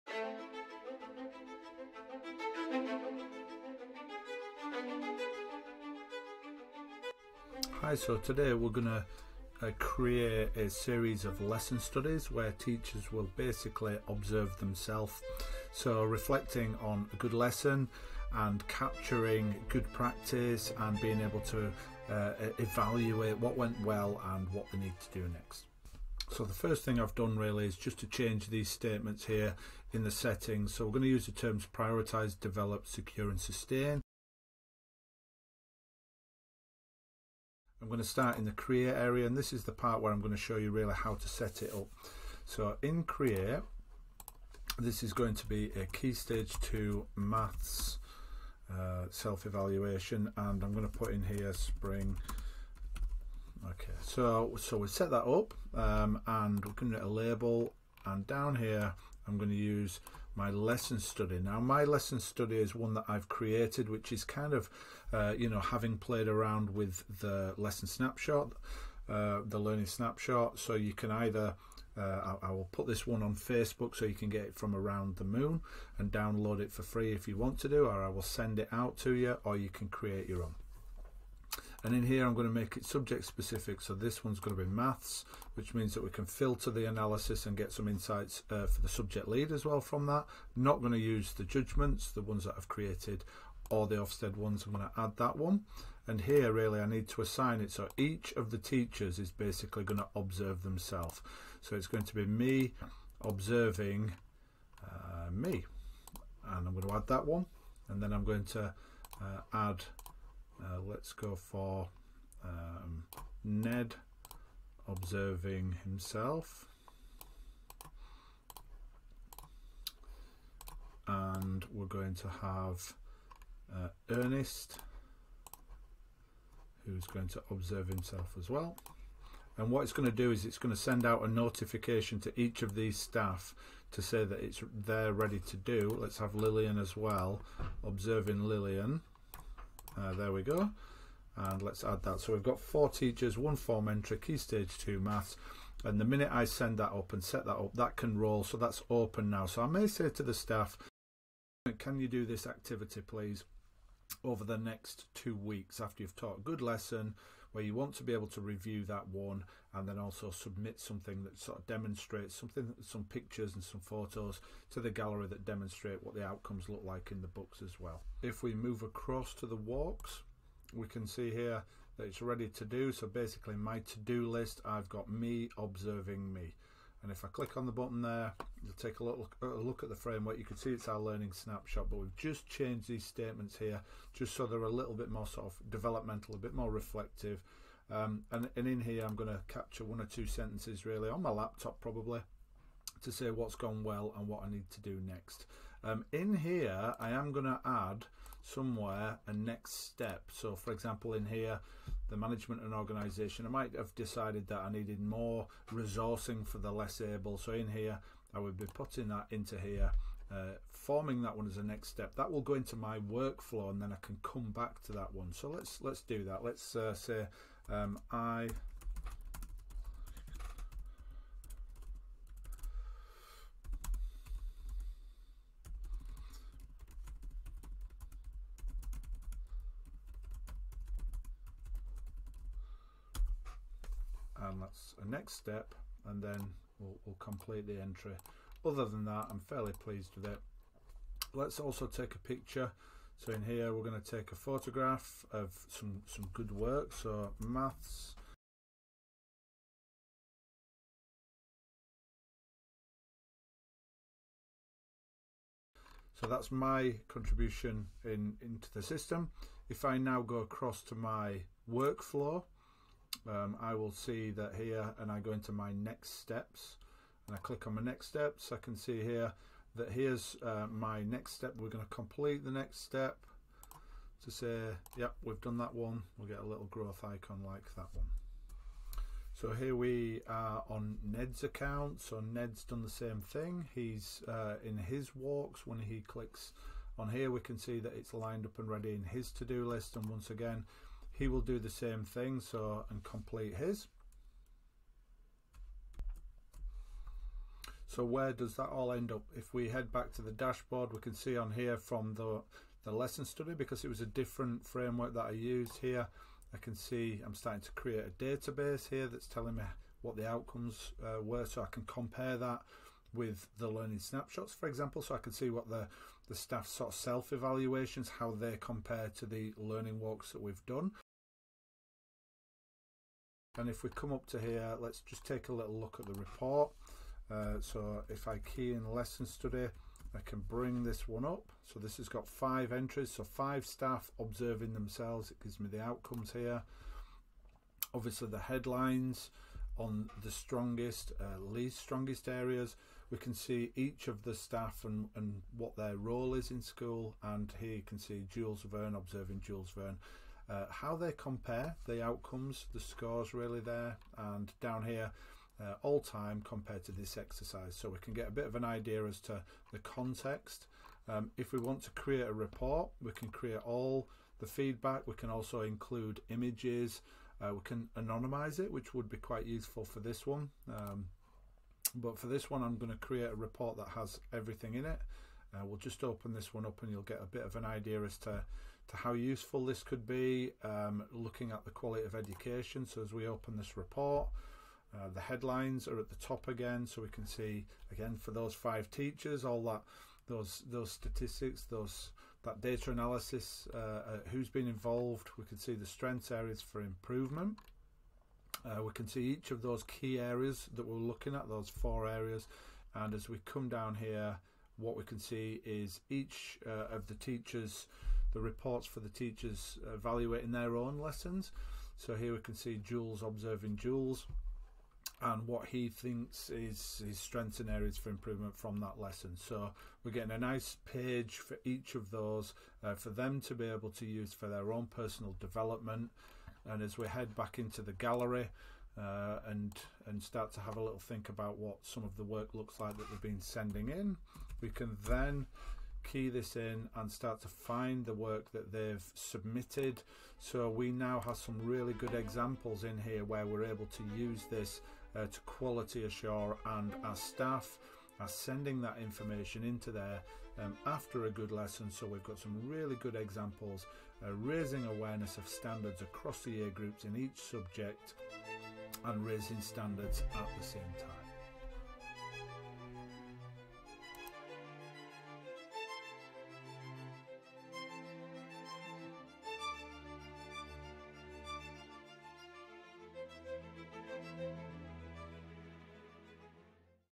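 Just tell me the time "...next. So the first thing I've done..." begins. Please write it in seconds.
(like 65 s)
25 s.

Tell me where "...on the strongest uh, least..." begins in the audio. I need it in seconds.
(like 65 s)
339 s.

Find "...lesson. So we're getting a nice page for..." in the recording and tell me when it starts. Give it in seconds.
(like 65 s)
418 s.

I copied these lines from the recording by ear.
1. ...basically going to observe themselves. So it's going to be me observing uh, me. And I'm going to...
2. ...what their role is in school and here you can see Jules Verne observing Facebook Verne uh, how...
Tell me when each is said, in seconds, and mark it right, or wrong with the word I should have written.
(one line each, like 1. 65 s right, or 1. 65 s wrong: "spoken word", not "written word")
1. 99 s right
2. 345 s wrong: "Jules", not "Facebook".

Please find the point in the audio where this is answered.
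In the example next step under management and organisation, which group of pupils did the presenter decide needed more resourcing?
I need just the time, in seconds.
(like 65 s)
206 s.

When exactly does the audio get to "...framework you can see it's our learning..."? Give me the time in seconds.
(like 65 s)
179 s.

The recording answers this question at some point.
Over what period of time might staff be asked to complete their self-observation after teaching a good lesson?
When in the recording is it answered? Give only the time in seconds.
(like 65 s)
155 s.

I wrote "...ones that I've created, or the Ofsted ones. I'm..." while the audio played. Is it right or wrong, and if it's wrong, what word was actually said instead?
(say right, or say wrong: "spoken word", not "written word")
right.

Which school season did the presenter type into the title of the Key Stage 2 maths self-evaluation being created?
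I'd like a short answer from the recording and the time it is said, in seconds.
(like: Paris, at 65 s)
spring, at 51 s.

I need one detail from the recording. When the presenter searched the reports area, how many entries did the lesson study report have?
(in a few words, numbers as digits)
5.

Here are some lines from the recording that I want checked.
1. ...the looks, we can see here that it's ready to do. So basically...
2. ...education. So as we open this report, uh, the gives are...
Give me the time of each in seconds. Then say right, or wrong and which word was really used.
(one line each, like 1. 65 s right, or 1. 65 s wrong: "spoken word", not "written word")
1. 169 s wrong: "walks", not "looks"
2. 382 s wrong: "headlines", not "gives".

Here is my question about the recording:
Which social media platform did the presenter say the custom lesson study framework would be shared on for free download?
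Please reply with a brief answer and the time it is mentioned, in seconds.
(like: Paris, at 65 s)
Facebook, at 73 s.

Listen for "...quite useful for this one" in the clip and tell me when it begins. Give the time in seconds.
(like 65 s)
369 s.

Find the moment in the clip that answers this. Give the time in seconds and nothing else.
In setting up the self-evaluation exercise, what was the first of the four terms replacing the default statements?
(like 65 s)
31 s.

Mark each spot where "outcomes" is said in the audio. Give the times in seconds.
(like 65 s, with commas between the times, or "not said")
166 s, 310 s, 335 s, 352 s.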